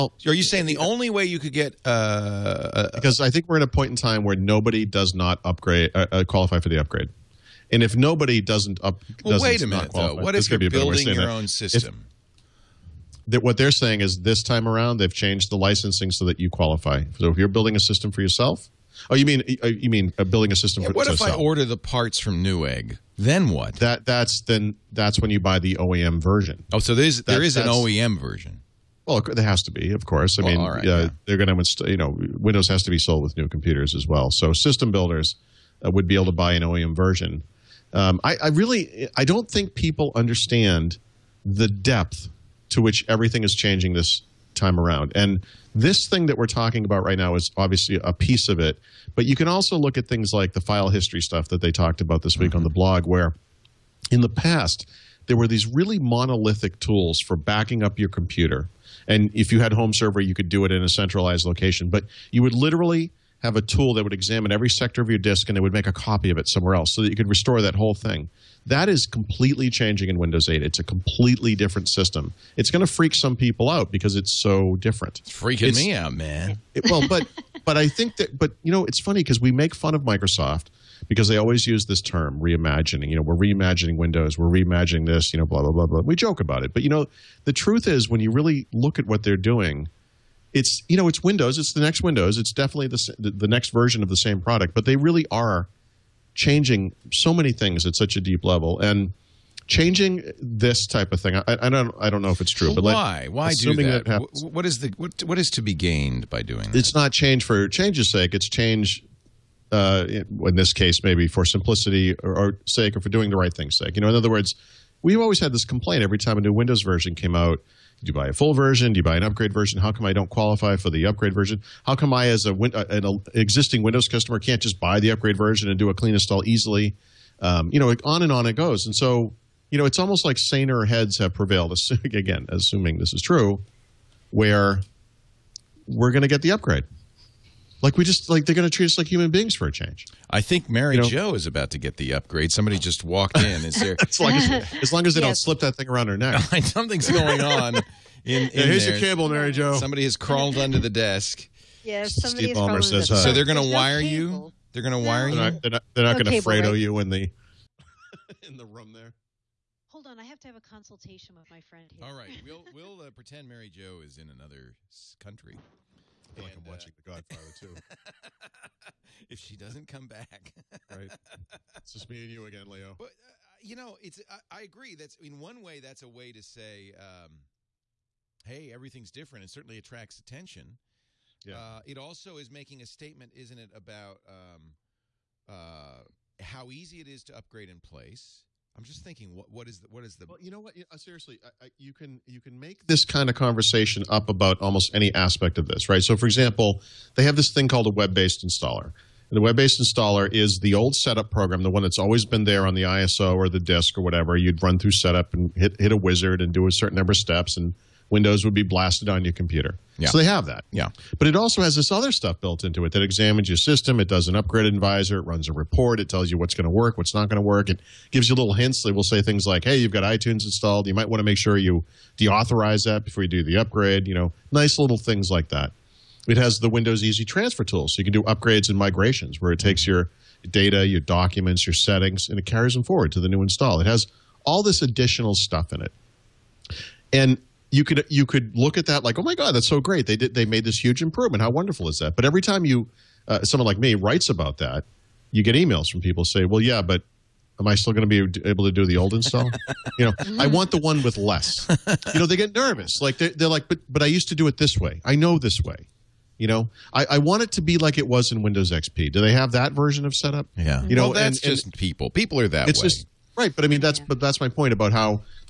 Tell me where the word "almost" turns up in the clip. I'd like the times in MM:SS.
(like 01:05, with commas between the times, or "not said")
02:09, 03:14.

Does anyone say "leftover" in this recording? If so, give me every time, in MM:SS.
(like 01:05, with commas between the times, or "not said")
not said.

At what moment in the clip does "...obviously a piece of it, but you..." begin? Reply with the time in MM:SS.
00:47.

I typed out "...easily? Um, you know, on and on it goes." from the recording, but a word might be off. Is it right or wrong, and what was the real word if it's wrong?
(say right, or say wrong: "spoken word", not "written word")
right.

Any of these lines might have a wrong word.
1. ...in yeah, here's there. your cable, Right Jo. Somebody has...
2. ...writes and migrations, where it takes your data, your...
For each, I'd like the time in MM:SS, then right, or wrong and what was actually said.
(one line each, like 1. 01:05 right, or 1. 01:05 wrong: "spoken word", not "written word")
1. 02:28 wrong: "Mary", not "Right"
2. 03:48 wrong: "upgrades", not "writes".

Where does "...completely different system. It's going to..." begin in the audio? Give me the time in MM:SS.
01:10.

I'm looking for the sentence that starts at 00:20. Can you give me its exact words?
Yeah, for, what if I order the parts from Newegg?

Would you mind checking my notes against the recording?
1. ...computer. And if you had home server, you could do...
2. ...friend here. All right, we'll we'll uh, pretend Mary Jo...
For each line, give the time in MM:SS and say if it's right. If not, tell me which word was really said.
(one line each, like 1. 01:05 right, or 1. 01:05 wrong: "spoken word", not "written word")
1. 00:58 right
2. 02:41 right.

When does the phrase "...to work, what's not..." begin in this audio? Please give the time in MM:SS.
03:36.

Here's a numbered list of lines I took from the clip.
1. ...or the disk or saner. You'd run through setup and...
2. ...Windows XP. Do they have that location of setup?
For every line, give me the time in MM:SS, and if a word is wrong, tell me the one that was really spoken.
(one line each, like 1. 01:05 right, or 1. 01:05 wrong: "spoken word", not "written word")
1. 03:23 wrong: "whatever", not "saner"
2. 04:18 wrong: "version", not "location".